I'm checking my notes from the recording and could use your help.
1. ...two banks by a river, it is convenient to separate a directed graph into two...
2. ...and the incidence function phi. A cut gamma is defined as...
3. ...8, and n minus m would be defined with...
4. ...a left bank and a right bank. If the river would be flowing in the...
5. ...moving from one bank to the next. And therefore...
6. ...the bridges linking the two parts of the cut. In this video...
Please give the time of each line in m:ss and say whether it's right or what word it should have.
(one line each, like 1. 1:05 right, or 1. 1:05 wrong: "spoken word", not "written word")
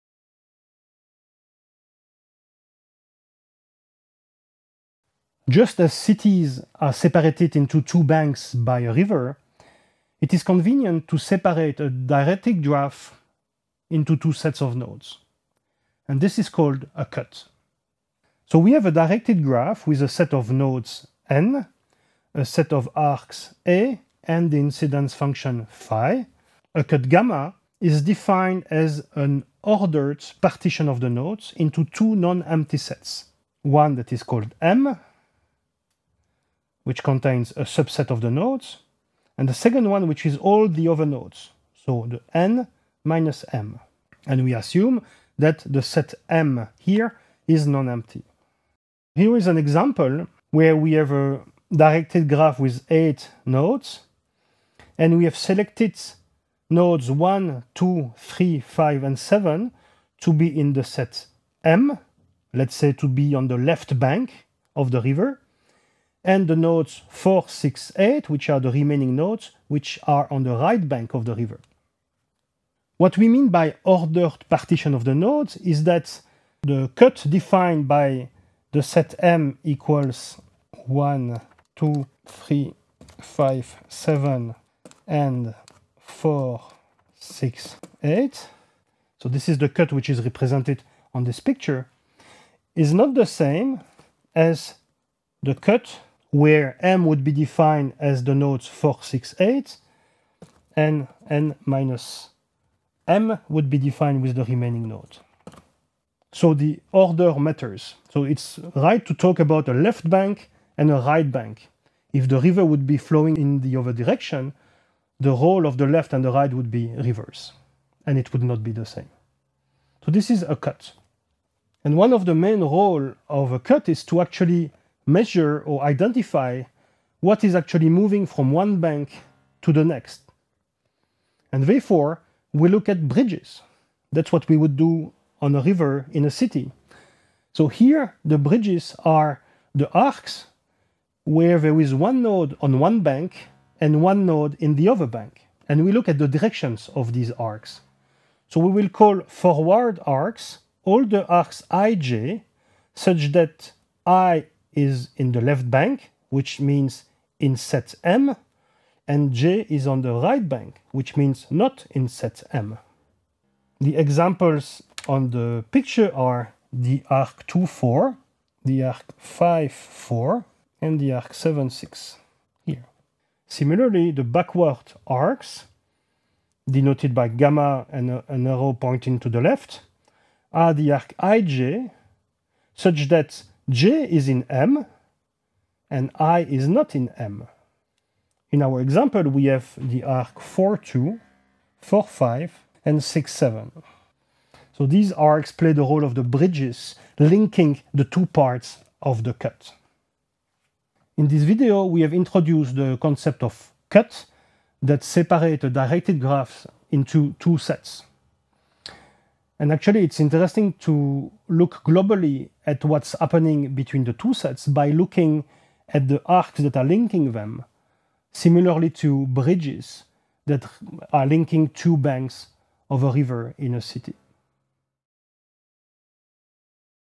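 1. 0:07 right
2. 0:24 right
3. 1:39 right
4. 1:49 right
5. 2:08 right
6. 3:16 right.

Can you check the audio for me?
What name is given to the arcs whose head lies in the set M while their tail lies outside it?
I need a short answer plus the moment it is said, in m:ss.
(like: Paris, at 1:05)
backward arcs, at 2:54.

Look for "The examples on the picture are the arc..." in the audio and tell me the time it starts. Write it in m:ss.
2:43.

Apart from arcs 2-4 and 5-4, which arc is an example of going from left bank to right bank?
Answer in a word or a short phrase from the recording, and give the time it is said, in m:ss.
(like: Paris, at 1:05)
7-6, at 2:51.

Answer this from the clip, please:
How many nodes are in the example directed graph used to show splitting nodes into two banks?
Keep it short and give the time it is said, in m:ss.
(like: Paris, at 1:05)
8, at 0:52.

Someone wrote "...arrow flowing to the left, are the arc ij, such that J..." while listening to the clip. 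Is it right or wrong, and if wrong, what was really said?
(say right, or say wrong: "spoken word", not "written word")
wrong: "pointing", not "flowing".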